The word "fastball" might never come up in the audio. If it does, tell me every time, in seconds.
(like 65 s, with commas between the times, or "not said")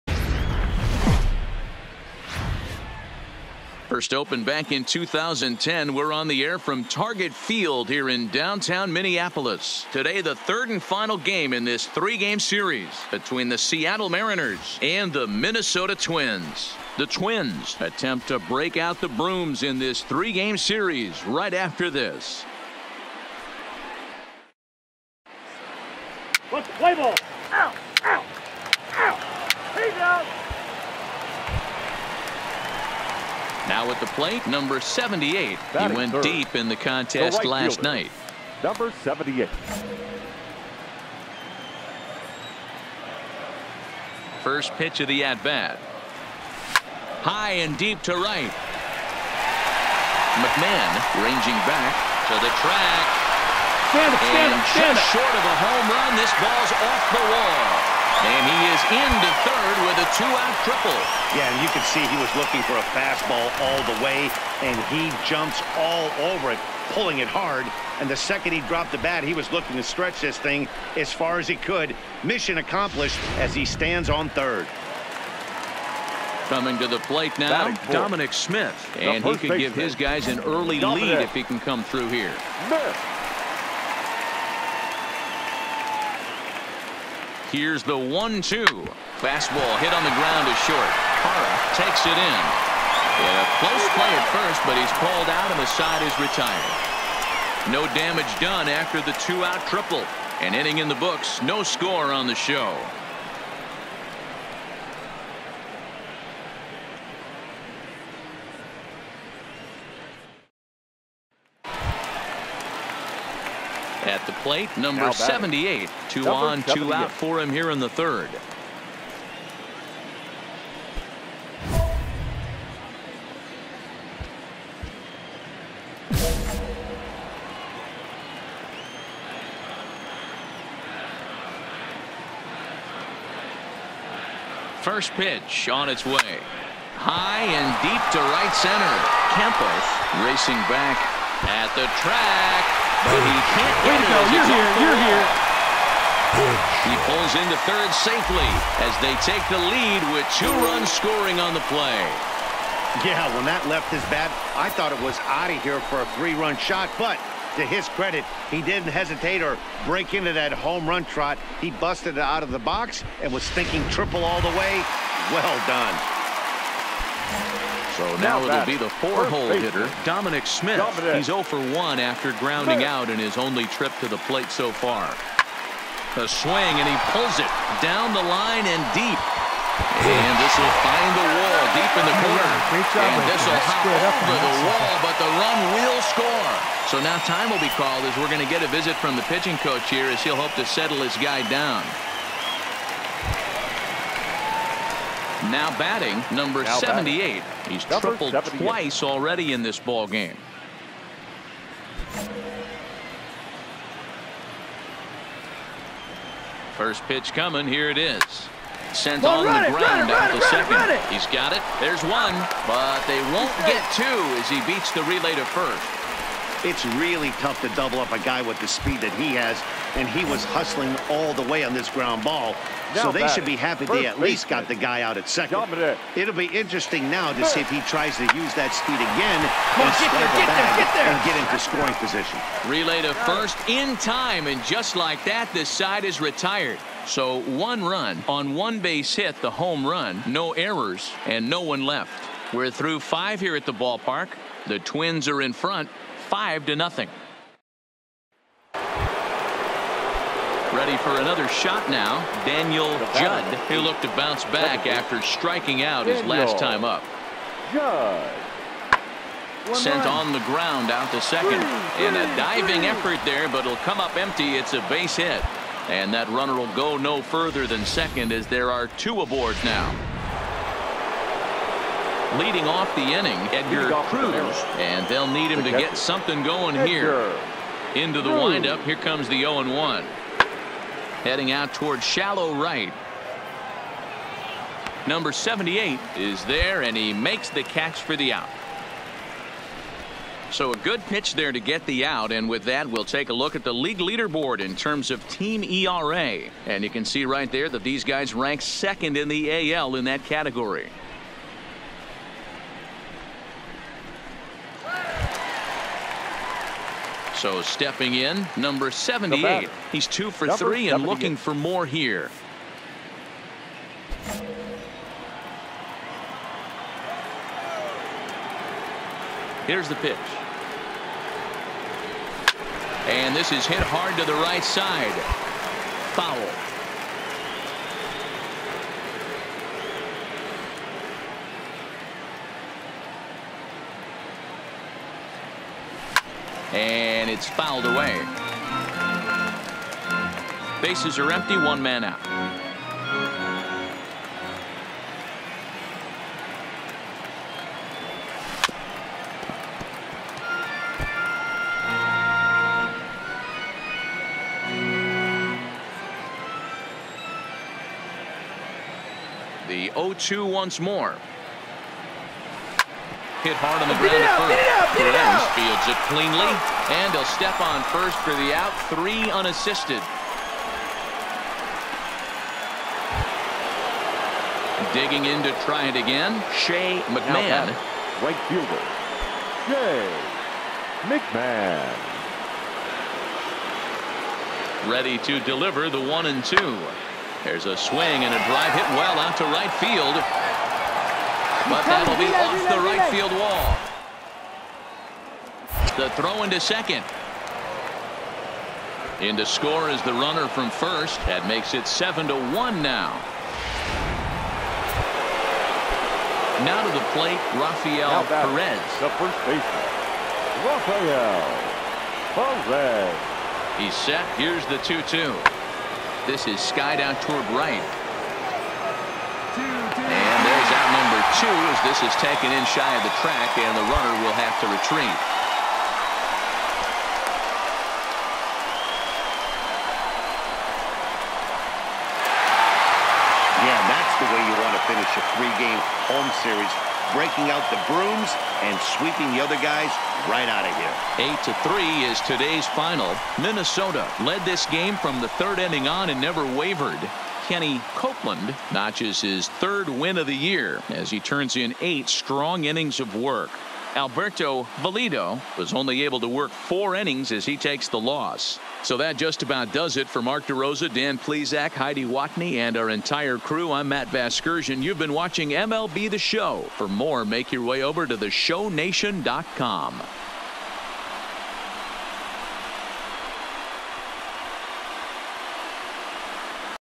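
62 s, 89 s.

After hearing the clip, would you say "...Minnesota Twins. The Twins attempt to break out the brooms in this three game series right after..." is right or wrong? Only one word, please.
right.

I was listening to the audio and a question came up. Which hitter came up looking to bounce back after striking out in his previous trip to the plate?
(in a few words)
Daniel Judd.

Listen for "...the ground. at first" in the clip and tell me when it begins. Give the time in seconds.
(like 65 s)
363 s.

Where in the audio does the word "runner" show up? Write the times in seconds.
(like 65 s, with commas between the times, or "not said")
266 s, 400 s, 423 s.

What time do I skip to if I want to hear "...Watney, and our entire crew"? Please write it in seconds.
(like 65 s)
462 s.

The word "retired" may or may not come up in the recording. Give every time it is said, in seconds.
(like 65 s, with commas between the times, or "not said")
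96 s, 236 s.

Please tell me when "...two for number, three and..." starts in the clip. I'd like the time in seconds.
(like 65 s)
310 s.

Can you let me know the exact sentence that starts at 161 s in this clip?
He busted it out of the box and was thinking triple all the way.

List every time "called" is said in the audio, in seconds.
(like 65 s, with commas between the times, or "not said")
95 s, 187 s.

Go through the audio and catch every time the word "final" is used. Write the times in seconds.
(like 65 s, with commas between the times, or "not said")
10 s, 442 s.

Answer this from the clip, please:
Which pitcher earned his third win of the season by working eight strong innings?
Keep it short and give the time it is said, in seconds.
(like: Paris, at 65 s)
Kenny Copeland, at 447 s.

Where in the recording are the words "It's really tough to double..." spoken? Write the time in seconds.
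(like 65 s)
216 s.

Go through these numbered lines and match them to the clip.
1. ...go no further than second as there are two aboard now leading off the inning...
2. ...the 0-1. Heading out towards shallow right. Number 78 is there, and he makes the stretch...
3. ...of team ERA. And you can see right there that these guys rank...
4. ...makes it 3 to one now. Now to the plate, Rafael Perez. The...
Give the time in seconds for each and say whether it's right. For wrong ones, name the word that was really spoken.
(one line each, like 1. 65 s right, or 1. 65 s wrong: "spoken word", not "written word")
1. 266 s right
2. 279 s wrong: "catch", not "stretch"
3. 295 s right
4. 401 s wrong: "7", not "3".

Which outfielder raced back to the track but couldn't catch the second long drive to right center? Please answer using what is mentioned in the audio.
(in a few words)
Campos.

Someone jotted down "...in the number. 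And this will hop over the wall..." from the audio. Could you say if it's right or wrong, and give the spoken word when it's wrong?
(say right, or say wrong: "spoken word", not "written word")
wrong: "corner", not "number".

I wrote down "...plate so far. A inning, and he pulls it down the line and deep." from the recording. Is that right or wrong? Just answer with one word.
wrong.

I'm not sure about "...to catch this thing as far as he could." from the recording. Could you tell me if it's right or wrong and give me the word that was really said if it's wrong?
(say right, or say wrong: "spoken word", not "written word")
wrong: "stretch", not "catch".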